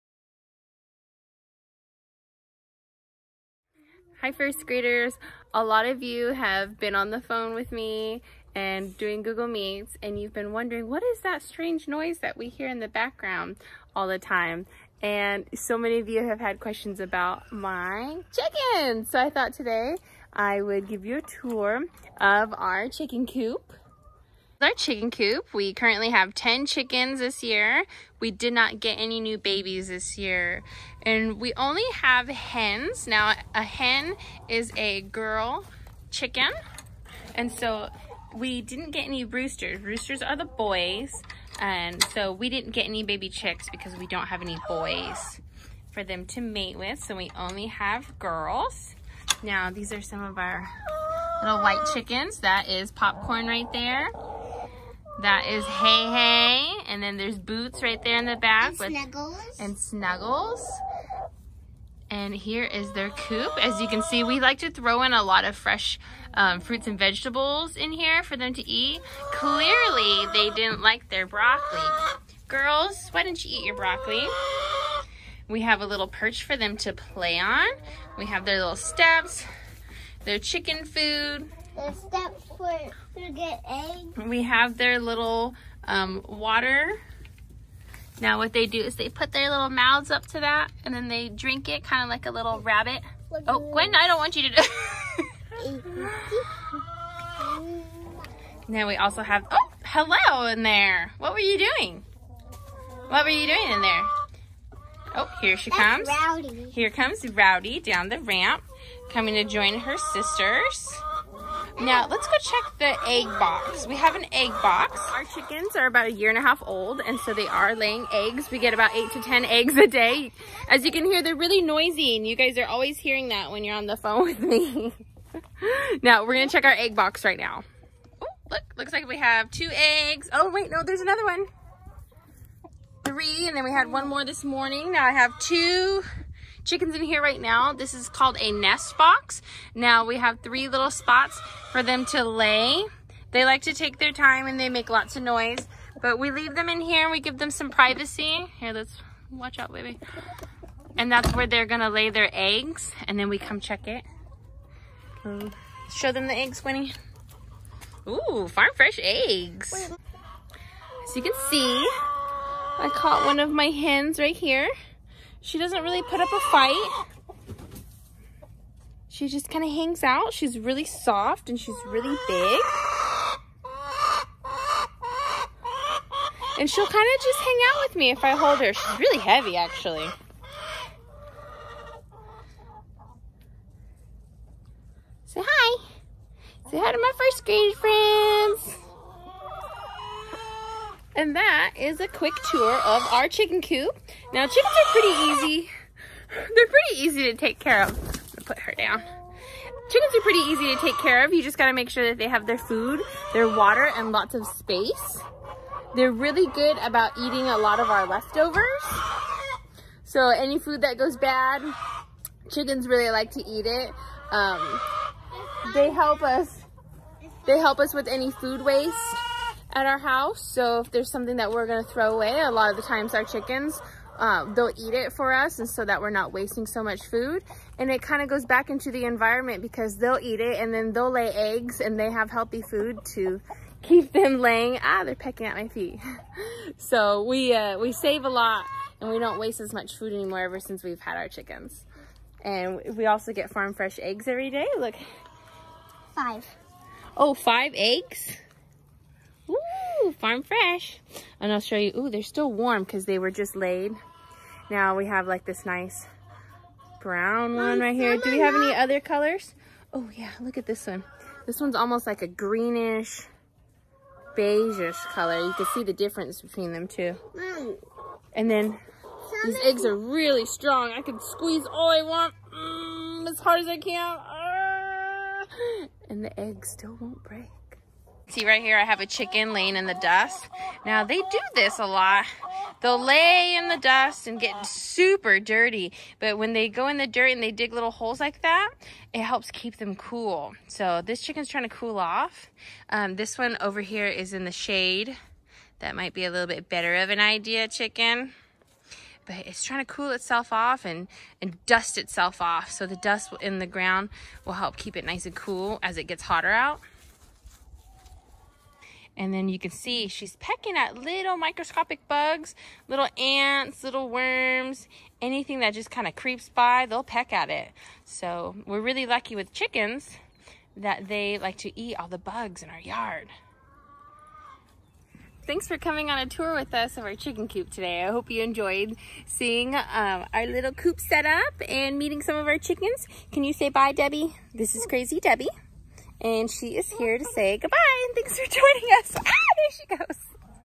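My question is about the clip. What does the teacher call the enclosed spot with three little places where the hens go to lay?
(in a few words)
Nest box.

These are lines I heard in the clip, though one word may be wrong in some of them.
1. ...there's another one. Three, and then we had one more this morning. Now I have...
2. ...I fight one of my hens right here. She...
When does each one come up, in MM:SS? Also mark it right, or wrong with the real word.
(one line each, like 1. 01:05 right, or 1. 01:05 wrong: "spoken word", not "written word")
1. 02:10 right
2. 02:41 wrong: "caught", not "fight".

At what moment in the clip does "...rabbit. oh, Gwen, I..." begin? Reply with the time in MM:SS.
01:32.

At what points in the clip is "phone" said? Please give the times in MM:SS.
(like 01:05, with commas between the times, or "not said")
00:07, 02:03.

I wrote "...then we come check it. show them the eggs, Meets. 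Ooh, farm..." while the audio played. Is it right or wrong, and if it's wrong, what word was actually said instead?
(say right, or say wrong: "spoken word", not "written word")
wrong: "Winnie", not "Meets".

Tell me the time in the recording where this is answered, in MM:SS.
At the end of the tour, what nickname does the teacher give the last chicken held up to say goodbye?
05:34.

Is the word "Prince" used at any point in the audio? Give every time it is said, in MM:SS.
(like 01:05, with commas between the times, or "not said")
not said.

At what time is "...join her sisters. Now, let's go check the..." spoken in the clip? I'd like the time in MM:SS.
01:49.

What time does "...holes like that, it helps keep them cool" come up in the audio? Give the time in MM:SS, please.
04:47.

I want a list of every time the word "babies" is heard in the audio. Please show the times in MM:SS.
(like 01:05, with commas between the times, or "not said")
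00:29.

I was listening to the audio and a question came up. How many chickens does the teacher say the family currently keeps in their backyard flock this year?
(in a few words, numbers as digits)
10.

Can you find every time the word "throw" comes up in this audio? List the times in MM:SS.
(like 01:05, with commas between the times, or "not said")
01:04, 03:41.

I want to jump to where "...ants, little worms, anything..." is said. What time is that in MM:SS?
05:13.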